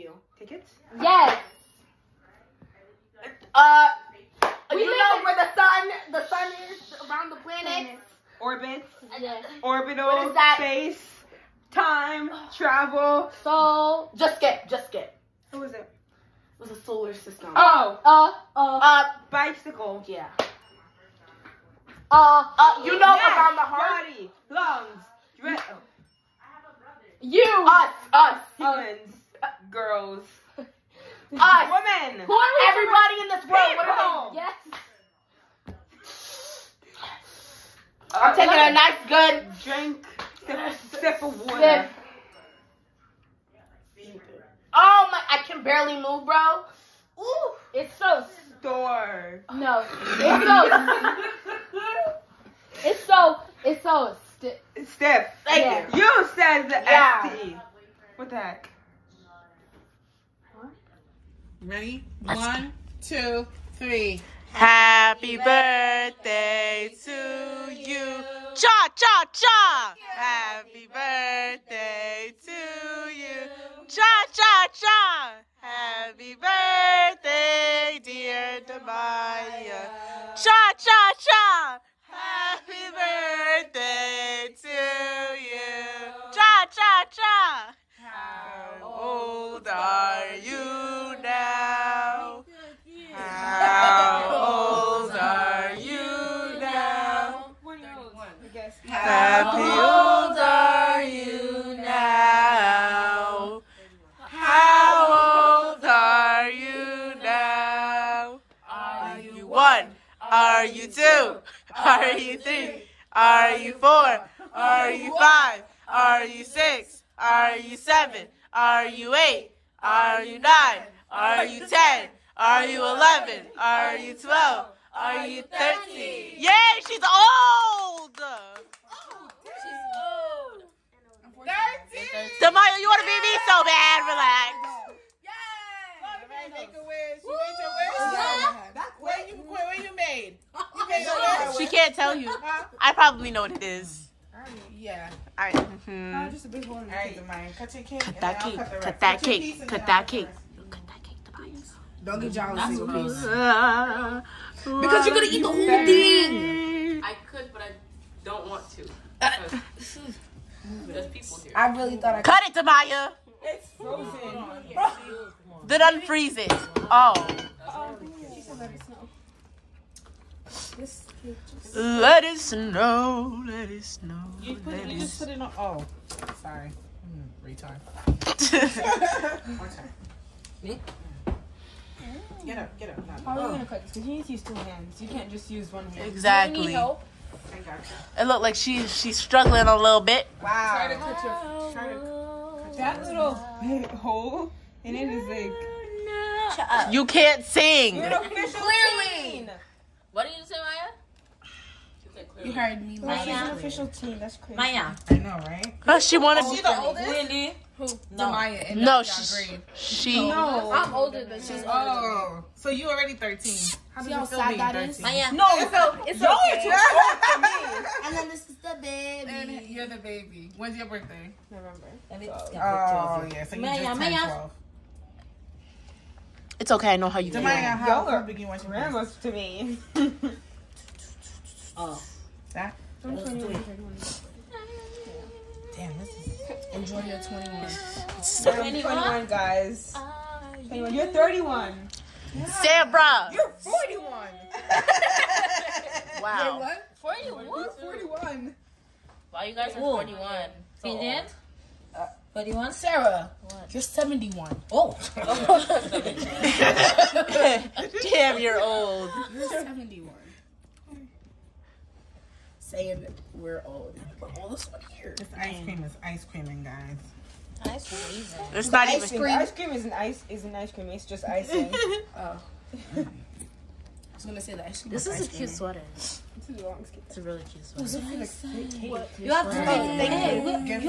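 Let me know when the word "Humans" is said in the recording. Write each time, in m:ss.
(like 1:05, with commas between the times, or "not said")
0:28.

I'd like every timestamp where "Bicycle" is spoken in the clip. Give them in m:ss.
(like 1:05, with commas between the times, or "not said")
0:19.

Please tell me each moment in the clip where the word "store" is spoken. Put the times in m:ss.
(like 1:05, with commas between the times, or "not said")
0:48.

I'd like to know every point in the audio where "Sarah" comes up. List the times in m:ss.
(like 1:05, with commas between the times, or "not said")
4:02, 4:12.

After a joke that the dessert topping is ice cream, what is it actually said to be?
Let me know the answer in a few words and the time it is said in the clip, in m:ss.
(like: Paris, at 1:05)
icing, at 4:31.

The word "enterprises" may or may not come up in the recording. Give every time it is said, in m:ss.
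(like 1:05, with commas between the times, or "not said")
not said.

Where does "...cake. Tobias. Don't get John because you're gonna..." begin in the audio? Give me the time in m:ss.
2:31.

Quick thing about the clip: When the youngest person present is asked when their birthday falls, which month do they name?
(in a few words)
November.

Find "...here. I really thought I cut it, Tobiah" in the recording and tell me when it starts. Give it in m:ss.
2:41.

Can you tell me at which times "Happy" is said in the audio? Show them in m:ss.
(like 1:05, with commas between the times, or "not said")
1:04, 1:10, 1:15.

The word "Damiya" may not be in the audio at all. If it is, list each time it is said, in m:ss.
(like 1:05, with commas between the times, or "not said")
1:18, 2:12, 3:47.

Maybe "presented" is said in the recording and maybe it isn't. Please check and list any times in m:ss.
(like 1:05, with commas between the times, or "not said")
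not said.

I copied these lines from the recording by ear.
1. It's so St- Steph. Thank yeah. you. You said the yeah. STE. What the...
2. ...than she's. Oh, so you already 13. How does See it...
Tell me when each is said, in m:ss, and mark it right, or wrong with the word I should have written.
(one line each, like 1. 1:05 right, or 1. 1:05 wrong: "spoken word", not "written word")
1. 0:53 right
2. 3:31 right.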